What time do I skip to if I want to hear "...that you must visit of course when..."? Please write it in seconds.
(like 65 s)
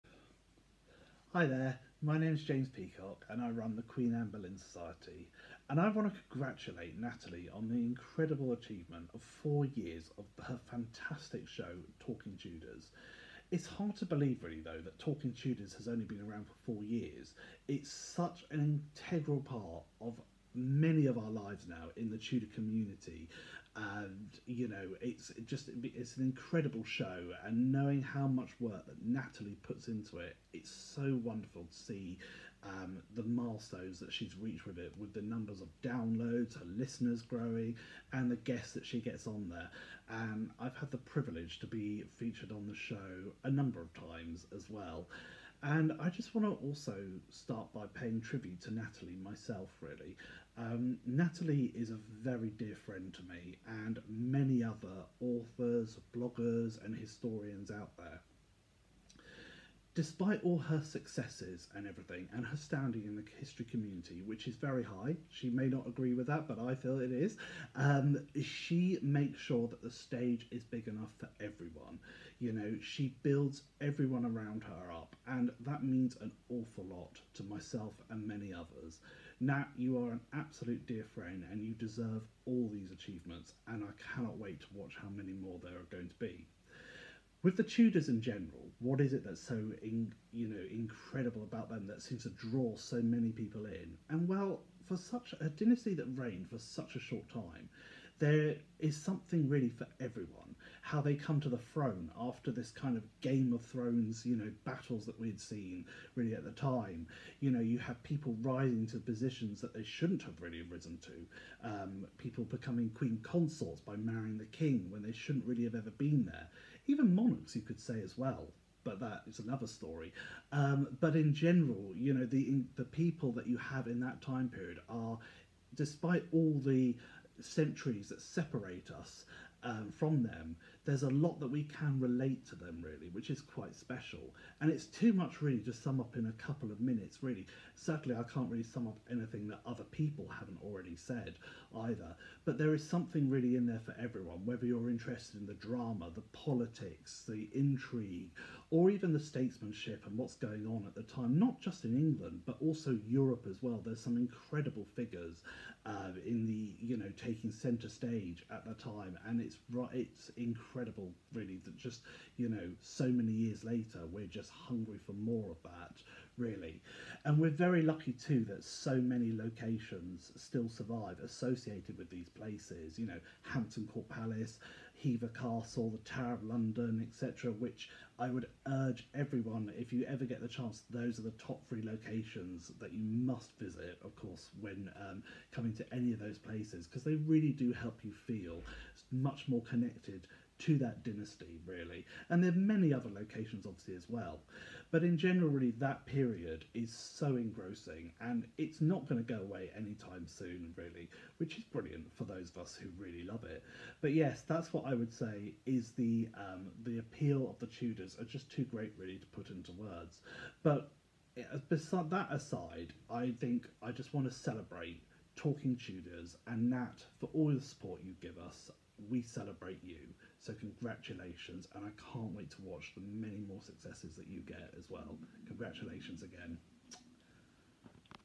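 182 s.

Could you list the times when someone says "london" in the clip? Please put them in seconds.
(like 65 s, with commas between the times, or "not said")
176 s.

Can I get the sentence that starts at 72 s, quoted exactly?
You know, she builds everyone around her up, and that means an awful lot to myself and many others.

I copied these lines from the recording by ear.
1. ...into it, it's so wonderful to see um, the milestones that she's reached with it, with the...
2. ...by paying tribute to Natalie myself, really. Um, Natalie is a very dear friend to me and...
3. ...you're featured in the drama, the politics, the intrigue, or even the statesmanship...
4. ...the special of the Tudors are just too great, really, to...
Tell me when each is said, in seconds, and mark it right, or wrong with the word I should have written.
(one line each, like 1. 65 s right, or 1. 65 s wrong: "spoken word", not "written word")
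1. 29 s right
2. 47 s right
3. 144 s wrong: "interested", not "featured"
4. 206 s wrong: "appeal", not "special".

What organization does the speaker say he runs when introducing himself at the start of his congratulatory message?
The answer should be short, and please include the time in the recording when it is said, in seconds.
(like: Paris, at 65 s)
Queen Anne Boleyn Society, at 3 s.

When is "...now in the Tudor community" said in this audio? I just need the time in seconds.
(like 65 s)
21 s.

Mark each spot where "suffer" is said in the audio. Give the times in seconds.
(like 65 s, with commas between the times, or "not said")
not said.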